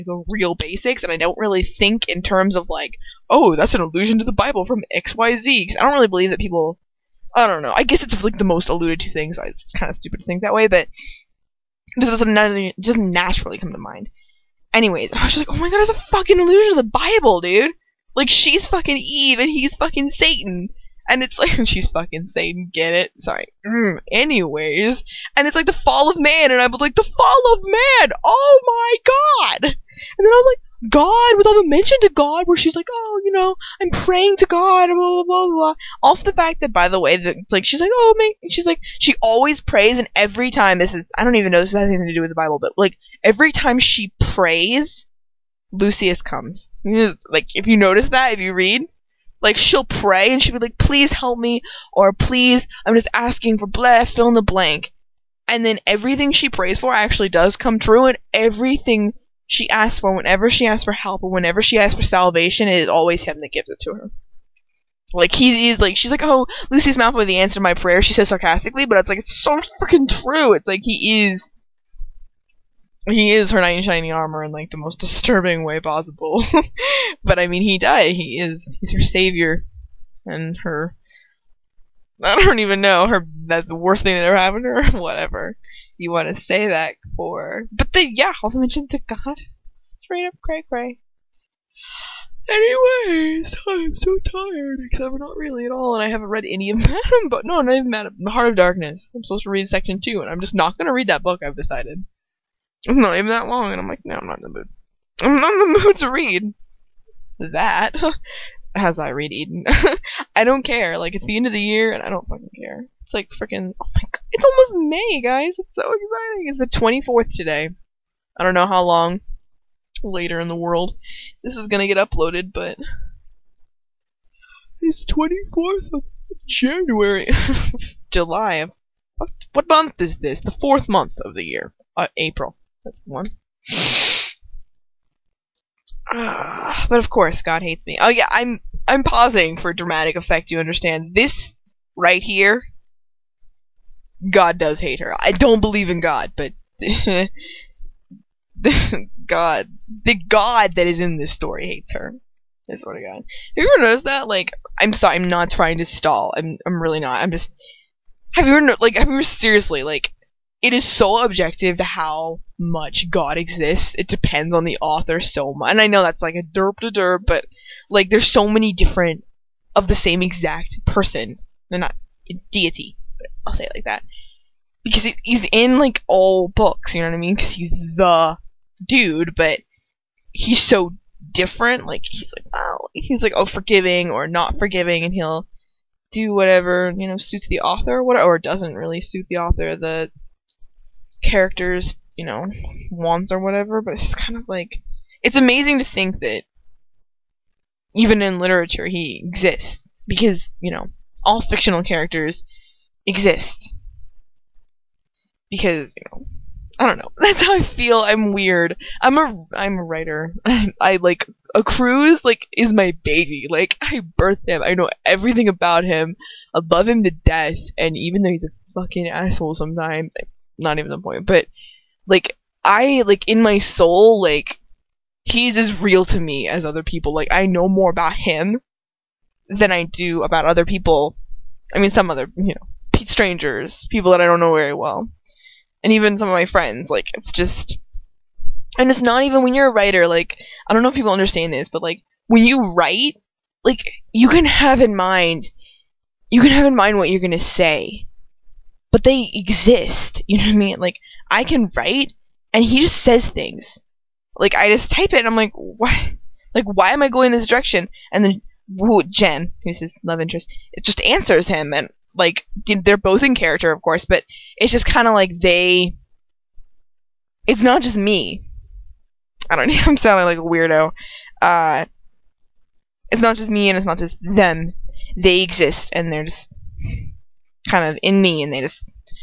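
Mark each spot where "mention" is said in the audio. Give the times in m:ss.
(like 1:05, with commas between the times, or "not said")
0:31, 1:28.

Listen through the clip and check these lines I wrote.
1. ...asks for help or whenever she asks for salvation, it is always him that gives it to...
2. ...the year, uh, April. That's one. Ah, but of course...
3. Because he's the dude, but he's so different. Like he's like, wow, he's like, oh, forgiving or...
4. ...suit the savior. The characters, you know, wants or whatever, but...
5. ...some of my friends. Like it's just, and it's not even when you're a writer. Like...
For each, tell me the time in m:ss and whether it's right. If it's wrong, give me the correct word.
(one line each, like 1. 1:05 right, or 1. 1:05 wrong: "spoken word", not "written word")
1. 1:00 right
2. 2:11 right
3. 2:57 right
4. 3:08 wrong: "author", not "savior"
5. 3:56 right.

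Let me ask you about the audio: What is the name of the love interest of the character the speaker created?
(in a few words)
Jen.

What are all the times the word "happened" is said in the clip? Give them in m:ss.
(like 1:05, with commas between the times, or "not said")
1:24.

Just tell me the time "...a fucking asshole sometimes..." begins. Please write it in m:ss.
3:38.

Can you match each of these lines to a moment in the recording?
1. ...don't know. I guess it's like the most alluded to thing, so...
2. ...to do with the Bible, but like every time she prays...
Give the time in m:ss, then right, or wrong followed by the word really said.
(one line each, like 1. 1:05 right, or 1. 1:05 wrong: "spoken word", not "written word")
1. 0:07 right
2. 0:42 right.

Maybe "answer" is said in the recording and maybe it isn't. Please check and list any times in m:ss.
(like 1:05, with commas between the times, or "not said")
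1:07, 4:21.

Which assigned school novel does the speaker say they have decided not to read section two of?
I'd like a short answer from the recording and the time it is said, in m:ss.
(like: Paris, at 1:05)
Heart of Darkness, at 1:38.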